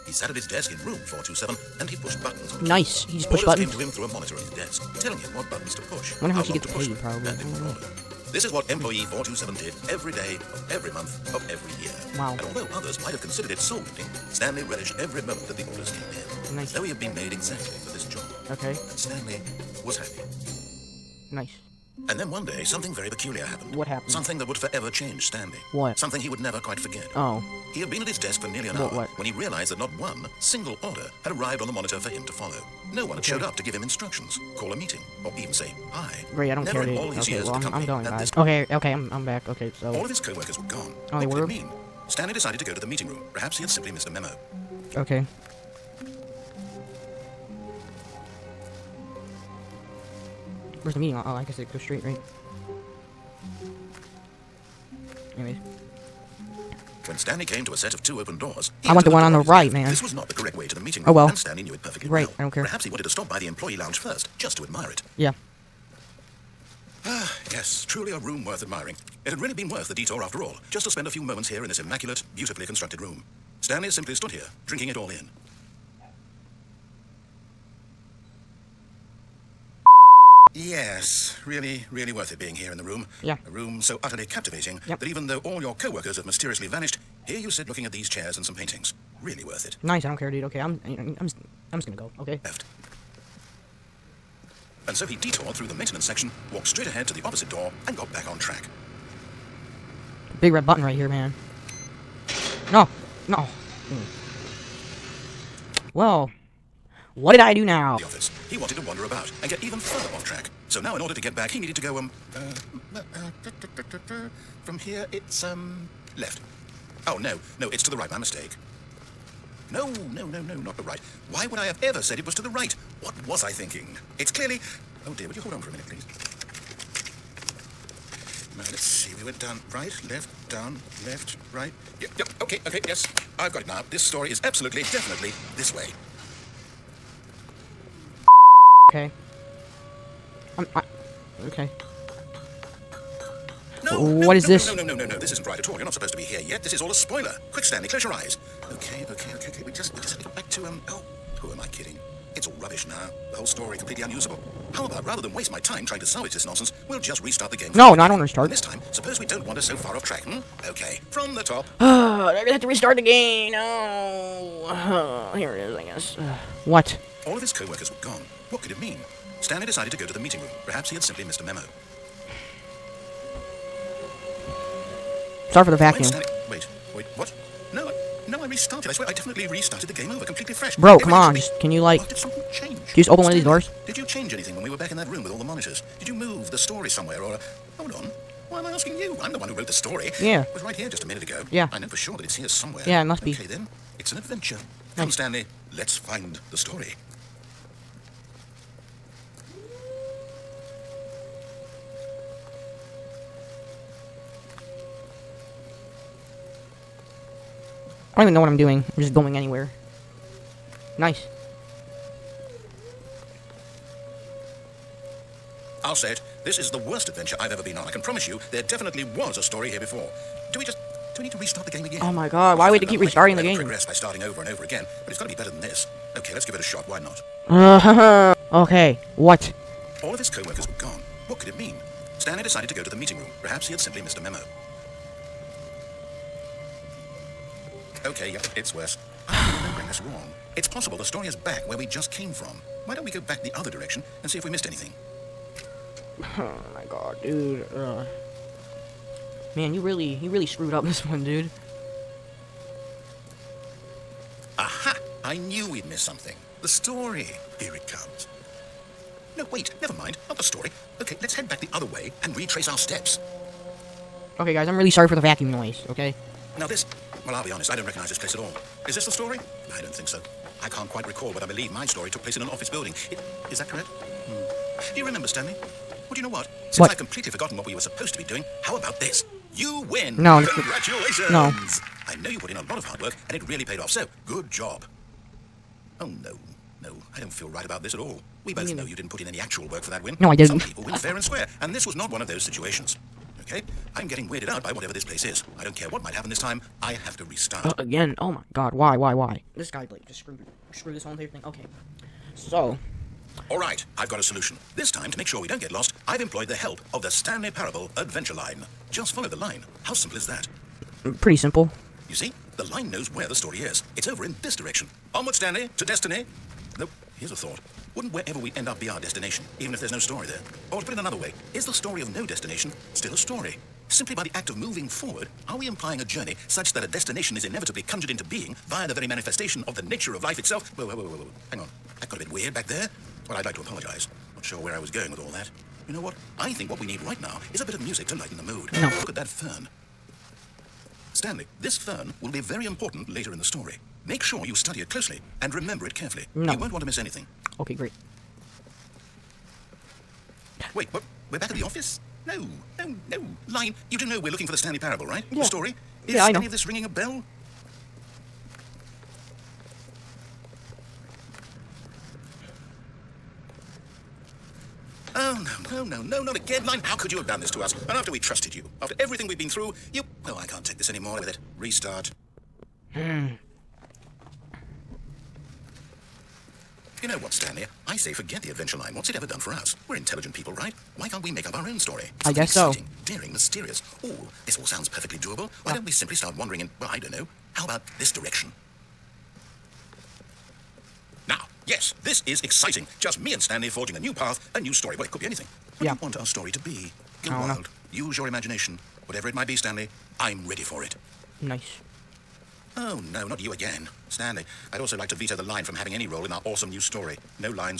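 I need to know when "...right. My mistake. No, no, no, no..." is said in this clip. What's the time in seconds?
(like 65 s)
117 s.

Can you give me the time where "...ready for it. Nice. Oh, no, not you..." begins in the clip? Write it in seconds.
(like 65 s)
400 s.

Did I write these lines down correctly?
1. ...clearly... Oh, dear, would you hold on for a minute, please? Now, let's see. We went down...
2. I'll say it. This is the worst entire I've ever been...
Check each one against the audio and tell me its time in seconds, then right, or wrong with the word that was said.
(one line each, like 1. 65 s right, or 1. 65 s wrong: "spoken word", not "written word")
1. 124 s right
2. 215 s wrong: "adventure", not "entire".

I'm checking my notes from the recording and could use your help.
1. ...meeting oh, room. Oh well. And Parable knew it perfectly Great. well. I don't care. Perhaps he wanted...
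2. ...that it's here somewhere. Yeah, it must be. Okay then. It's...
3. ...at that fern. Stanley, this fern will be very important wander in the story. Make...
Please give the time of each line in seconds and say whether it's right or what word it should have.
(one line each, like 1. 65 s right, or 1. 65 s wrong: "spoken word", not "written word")
1. 60 s wrong: "Stanley", not "Parable"
2. 192 s right
3. 339 s wrong: "later", not "wander".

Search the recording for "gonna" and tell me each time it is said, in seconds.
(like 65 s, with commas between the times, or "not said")
91 s, 162 s.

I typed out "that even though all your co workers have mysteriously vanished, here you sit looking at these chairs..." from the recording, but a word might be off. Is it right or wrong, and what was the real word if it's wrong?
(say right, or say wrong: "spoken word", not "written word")
right.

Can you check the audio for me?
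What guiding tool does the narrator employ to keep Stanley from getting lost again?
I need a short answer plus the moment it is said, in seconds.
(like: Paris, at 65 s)
Stanley Parable Adventure Line, at 307 s.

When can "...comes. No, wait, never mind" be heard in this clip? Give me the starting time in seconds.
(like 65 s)
257 s.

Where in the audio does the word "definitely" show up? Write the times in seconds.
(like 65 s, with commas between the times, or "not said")
134 s, 179 s, 218 s.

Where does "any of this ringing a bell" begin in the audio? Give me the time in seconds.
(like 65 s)
356 s.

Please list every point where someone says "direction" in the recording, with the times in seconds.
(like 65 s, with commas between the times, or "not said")
243 s, 314 s, 388 s.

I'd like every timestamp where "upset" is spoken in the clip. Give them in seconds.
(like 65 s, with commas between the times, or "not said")
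not said.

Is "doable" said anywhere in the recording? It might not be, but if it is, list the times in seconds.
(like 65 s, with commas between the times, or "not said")
385 s.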